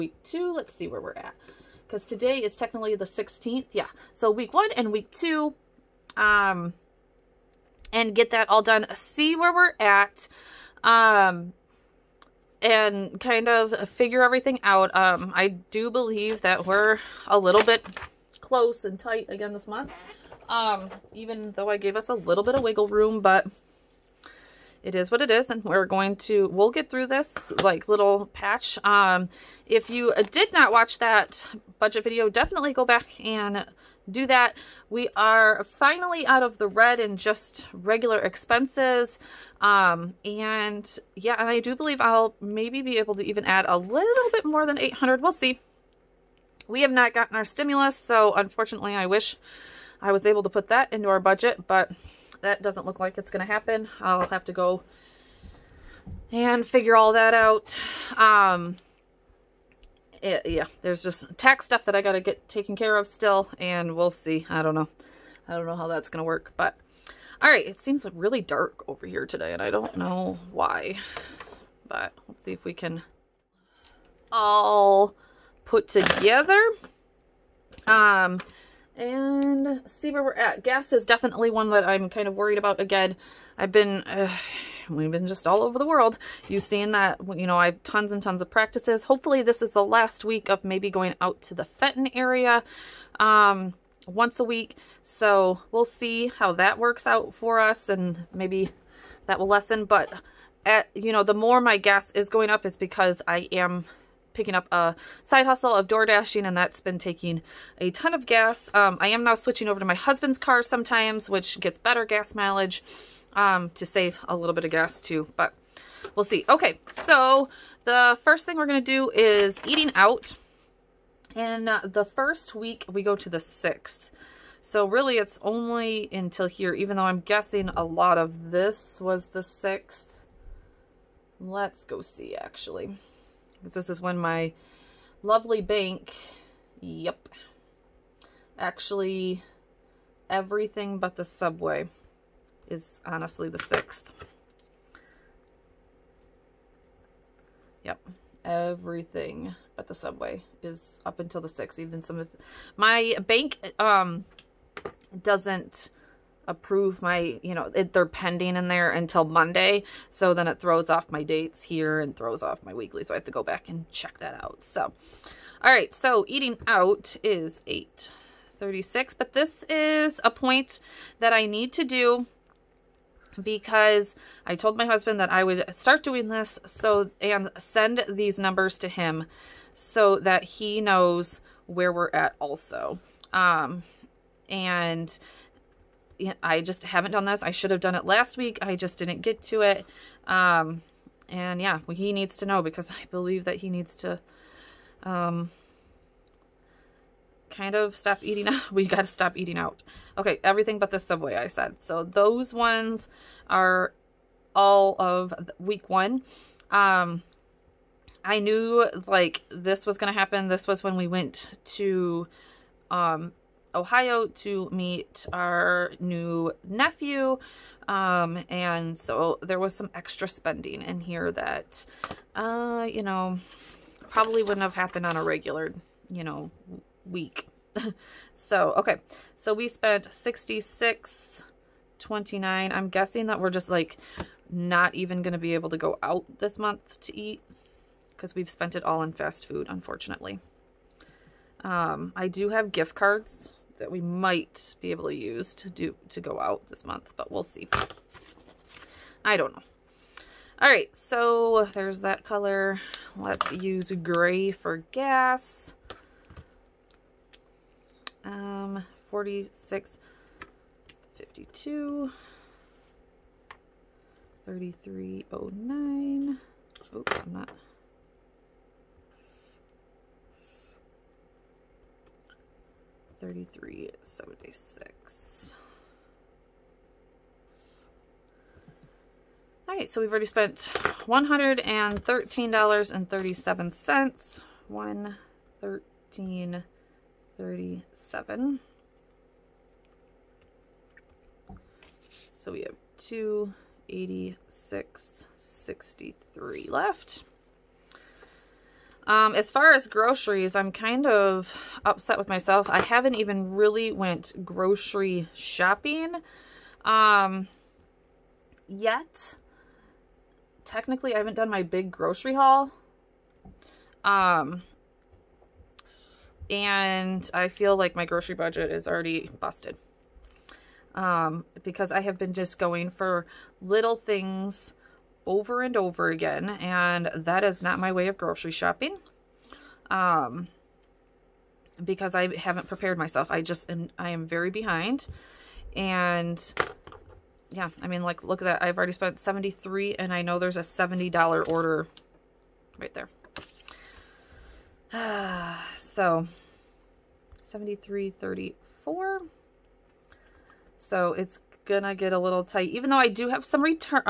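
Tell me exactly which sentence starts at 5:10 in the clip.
Technically, I haven't done my big grocery haul.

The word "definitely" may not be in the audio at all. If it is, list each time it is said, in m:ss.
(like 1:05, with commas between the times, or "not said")
0:32, 1:21.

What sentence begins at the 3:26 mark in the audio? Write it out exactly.
Um, I knew like this was going to happen.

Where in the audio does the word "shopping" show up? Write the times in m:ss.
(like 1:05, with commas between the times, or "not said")
5:05, 5:28.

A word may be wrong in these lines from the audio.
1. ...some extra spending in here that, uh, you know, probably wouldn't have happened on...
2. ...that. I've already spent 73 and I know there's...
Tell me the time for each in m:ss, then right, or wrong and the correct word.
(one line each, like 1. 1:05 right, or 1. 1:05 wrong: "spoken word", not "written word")
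1. 3:39 right
2. 5:38 right.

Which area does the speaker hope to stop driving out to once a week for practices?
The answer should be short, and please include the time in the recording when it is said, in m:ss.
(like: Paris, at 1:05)
Fenton, at 1:31.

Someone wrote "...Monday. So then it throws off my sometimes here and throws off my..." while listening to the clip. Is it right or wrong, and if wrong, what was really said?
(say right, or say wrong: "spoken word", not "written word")
wrong: "dates", not "sometimes".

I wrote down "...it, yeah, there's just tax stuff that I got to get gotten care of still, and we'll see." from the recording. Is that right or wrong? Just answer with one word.
wrong.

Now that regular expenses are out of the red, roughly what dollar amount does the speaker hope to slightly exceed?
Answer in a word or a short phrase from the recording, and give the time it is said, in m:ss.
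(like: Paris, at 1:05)
800, at 0:44.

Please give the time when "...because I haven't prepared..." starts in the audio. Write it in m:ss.
5:31.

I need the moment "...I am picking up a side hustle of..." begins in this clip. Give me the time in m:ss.
1:43.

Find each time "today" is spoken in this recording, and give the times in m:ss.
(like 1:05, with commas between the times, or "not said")
0:02, 1:09.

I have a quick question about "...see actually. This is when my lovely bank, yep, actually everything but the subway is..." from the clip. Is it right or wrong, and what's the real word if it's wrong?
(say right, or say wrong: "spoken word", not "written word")
right.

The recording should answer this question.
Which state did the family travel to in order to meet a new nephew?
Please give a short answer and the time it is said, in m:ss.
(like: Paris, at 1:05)
Ohio, at 3:33.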